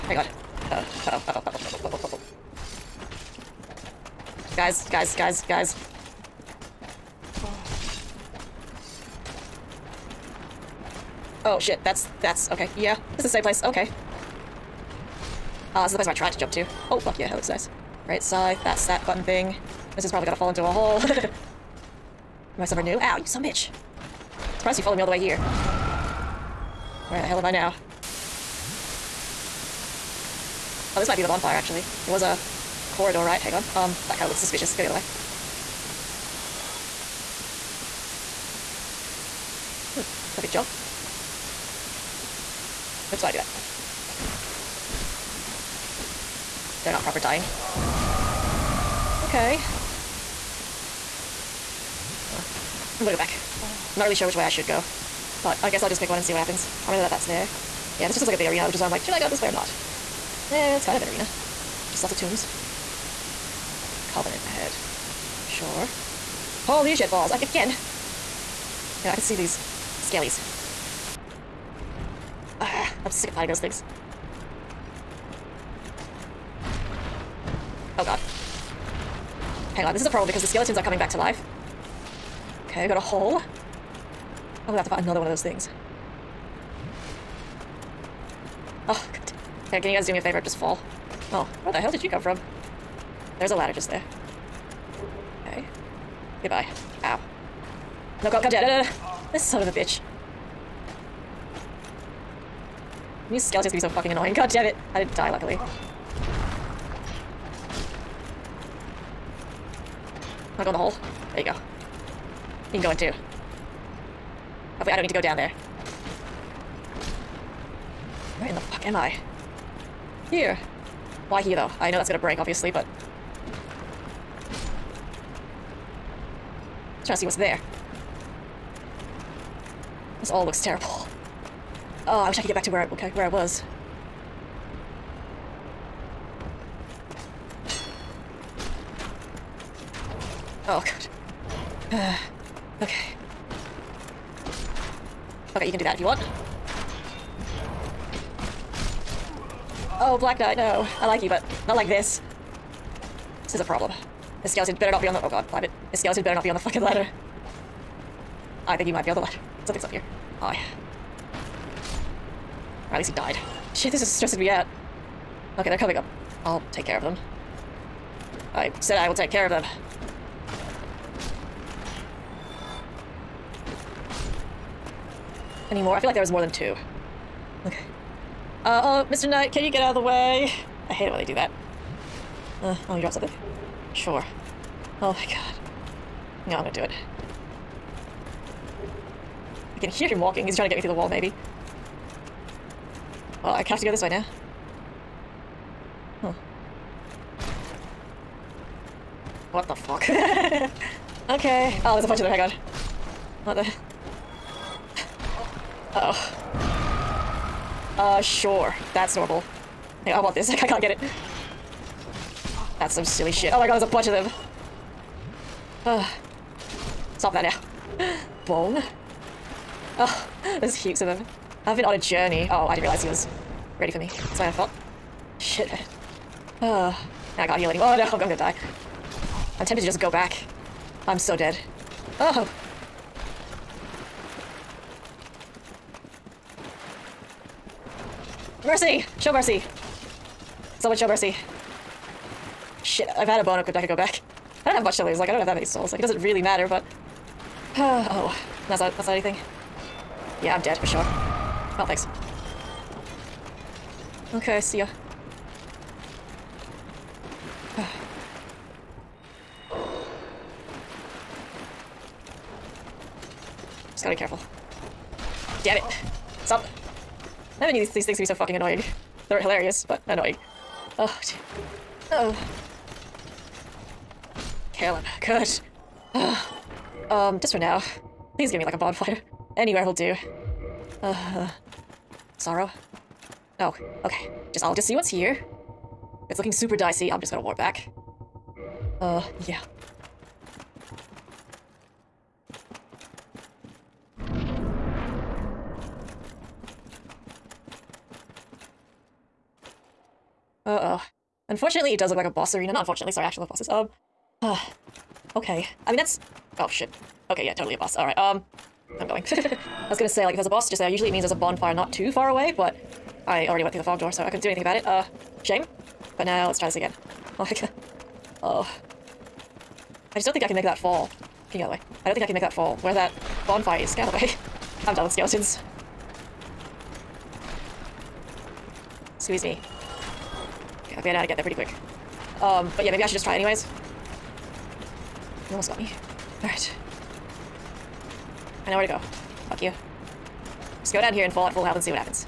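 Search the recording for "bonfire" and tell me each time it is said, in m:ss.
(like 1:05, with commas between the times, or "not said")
0:31, 4:38, 5:11, 5:23.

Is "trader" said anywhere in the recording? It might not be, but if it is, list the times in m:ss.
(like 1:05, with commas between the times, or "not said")
not said.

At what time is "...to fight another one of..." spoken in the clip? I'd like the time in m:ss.
1:24.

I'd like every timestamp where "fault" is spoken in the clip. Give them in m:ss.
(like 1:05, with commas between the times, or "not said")
3:44.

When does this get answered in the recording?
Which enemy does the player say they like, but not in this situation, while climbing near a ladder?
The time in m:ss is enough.
2:30.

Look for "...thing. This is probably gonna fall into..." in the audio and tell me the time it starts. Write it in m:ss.
0:19.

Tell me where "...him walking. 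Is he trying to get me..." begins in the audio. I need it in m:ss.
3:10.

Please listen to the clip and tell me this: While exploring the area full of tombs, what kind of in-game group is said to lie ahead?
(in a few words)
Covenant.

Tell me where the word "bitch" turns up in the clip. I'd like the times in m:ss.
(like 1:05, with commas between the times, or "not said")
0:23, 1:39.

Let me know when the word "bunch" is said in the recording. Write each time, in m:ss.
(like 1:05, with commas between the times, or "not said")
3:22, 3:33.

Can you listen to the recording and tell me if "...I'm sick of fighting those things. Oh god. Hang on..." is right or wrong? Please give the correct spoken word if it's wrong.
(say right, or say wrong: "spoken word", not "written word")
right.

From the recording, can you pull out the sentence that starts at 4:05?
Like, it doesn't really matter, but...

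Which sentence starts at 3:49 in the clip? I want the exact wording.
I'm tempted to just go back.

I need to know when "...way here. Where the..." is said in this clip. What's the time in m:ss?
0:25.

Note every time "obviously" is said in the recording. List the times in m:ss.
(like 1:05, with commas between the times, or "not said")
2:02.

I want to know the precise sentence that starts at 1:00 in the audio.
Yeah, it's kind of an arena.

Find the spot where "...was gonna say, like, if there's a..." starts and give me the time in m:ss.
5:09.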